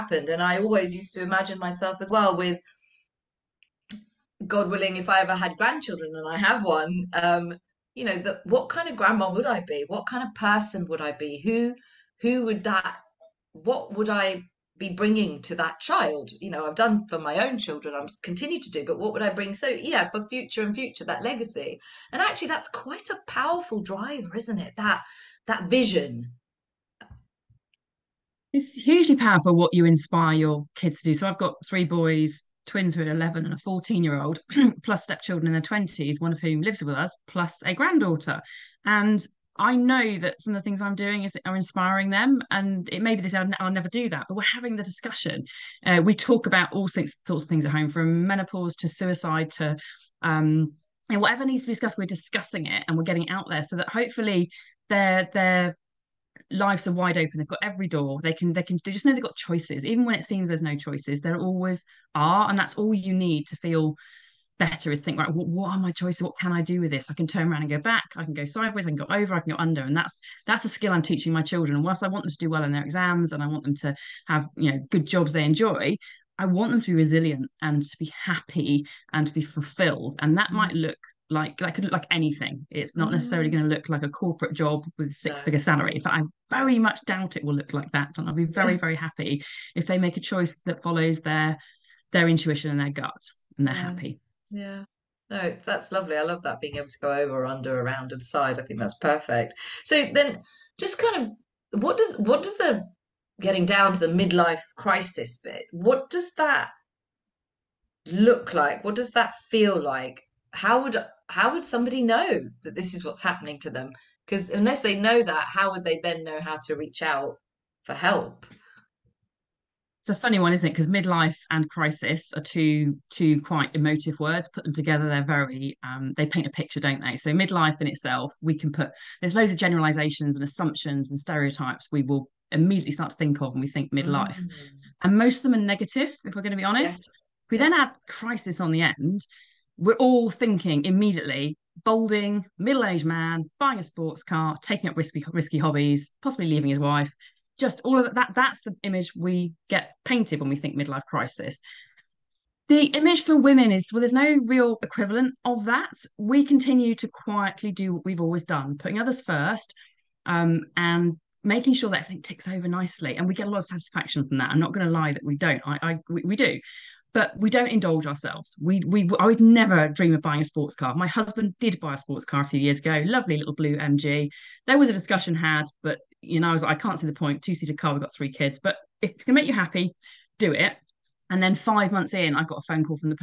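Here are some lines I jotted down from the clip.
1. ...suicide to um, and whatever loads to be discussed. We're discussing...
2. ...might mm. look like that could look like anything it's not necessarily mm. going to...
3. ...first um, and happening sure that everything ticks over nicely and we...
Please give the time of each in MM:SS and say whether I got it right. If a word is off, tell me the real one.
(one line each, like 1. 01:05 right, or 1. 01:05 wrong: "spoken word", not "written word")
1. 00:48 wrong: "needs", not "loads"
2. 01:20 right
3. 02:39 wrong: "making", not "happening".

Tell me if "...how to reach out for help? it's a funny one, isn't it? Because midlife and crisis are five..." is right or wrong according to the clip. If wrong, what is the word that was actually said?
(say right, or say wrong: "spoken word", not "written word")
wrong: "two", not "five".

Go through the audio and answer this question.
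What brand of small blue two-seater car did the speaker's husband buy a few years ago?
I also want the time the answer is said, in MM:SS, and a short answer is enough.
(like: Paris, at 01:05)
MG, at 02:53.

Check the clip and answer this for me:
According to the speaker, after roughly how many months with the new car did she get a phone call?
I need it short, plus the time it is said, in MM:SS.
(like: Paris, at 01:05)
5, at 03:01.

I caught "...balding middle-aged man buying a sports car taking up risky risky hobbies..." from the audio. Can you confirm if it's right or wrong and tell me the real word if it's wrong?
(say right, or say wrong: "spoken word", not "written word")
right.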